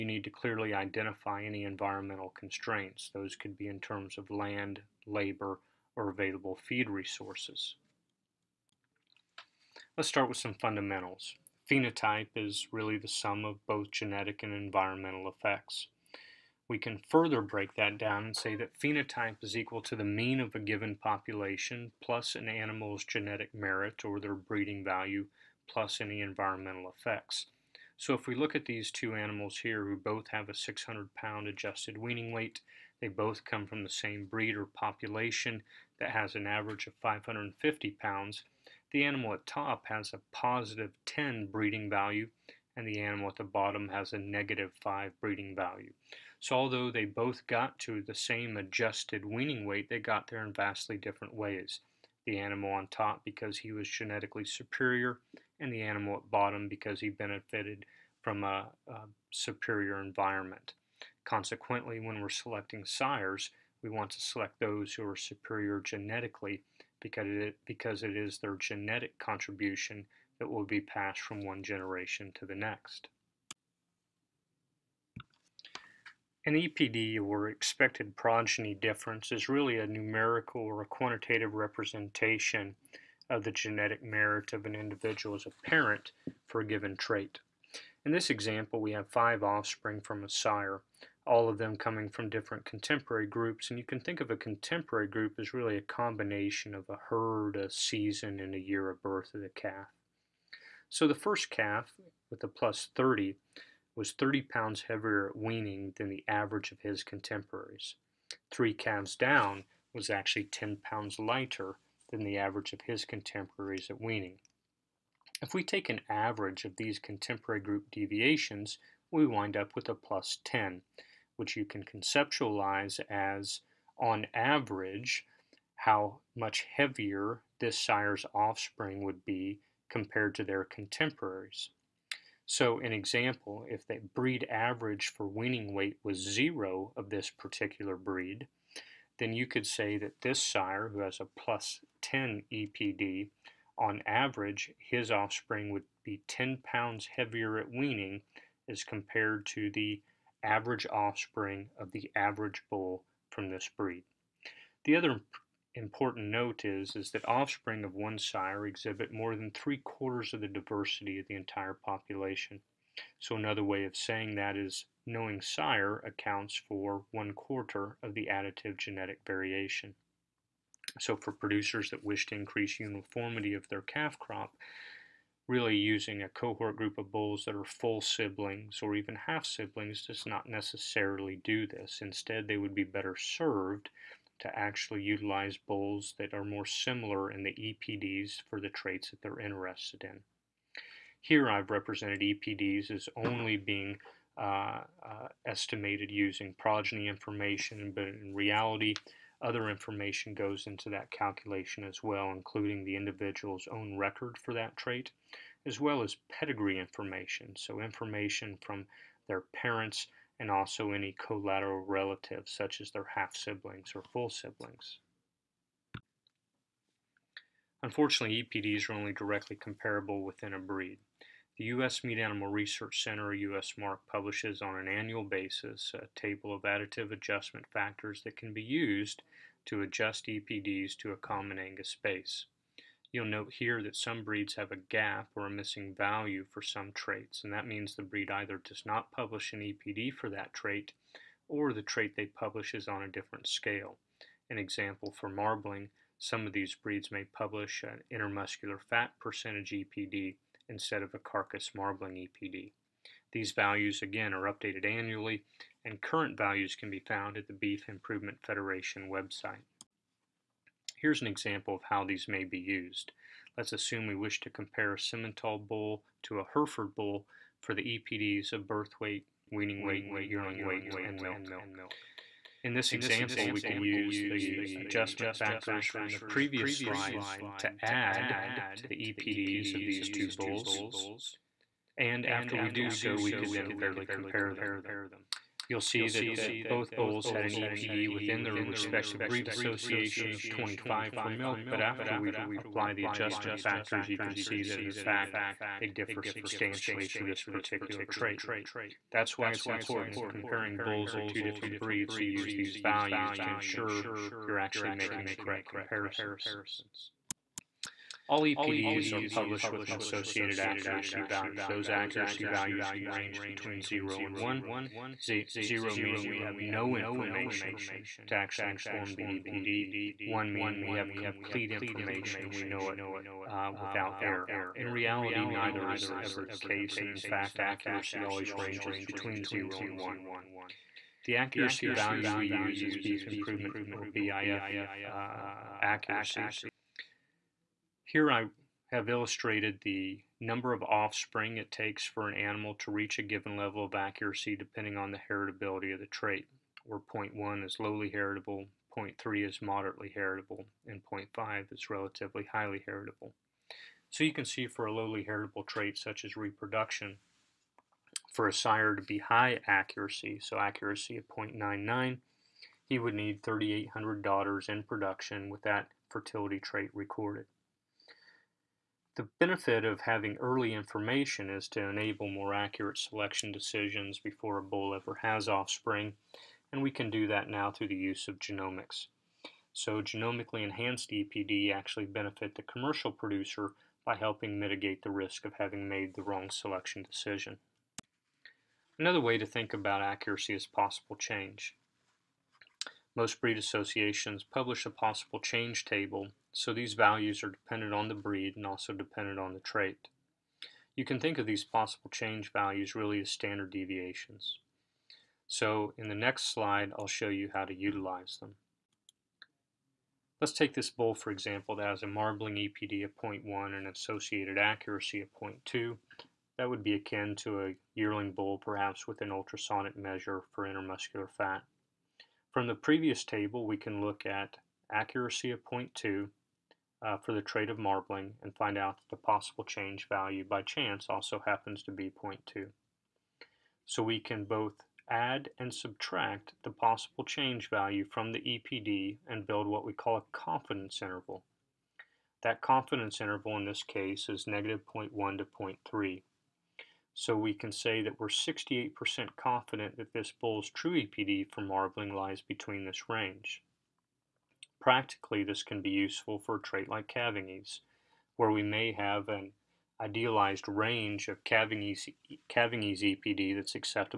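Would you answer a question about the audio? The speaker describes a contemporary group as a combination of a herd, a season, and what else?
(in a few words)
year of birth.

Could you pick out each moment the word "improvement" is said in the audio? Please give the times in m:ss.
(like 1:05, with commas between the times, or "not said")
4:17, 5:33.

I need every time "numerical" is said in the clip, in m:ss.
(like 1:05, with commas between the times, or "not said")
1:19.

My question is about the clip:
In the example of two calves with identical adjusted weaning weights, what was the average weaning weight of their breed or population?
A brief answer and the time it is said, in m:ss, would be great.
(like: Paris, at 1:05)
550 pounds, at 0:37.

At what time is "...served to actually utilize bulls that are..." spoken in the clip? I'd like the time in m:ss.
3:03.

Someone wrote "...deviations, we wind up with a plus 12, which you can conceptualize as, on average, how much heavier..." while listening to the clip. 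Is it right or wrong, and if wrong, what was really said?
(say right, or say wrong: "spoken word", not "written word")
wrong: "10", not "12".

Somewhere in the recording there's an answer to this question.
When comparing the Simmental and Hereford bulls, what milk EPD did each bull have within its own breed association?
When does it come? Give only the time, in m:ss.
4:50.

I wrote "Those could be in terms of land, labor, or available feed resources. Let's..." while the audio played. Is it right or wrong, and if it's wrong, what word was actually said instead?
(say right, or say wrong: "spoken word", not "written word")
right.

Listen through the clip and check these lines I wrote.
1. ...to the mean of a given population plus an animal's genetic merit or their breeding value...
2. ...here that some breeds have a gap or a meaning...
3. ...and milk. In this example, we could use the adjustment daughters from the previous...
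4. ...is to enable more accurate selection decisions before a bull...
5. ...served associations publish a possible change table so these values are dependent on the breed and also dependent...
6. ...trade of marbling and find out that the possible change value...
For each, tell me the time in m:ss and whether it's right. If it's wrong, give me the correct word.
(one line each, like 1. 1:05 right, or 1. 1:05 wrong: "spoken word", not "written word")
1. 0:19 right
2. 3:53 wrong: "missing", not "meaning"
3. 4:31 wrong: "factors", not "daughters"
4. 6:11 right
5. 6:33 wrong: "breed", not "served"
6. 7:07 right.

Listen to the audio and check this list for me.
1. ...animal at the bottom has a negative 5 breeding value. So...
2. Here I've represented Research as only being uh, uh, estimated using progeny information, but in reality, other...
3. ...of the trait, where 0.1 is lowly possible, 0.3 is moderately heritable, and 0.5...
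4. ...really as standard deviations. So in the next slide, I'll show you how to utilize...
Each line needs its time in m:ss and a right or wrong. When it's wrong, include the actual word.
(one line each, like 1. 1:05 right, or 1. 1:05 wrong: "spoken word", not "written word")
1. 0:43 right
2. 3:11 wrong: "EPDs", not "Research"
3. 5:45 wrong: "heritable", not "possible"
4. 6:42 right.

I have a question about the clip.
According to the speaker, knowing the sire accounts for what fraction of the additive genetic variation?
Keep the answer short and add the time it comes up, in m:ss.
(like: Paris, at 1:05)
one quarter, at 2:47.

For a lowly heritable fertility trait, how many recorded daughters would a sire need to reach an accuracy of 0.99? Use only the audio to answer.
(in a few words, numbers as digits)
3,800.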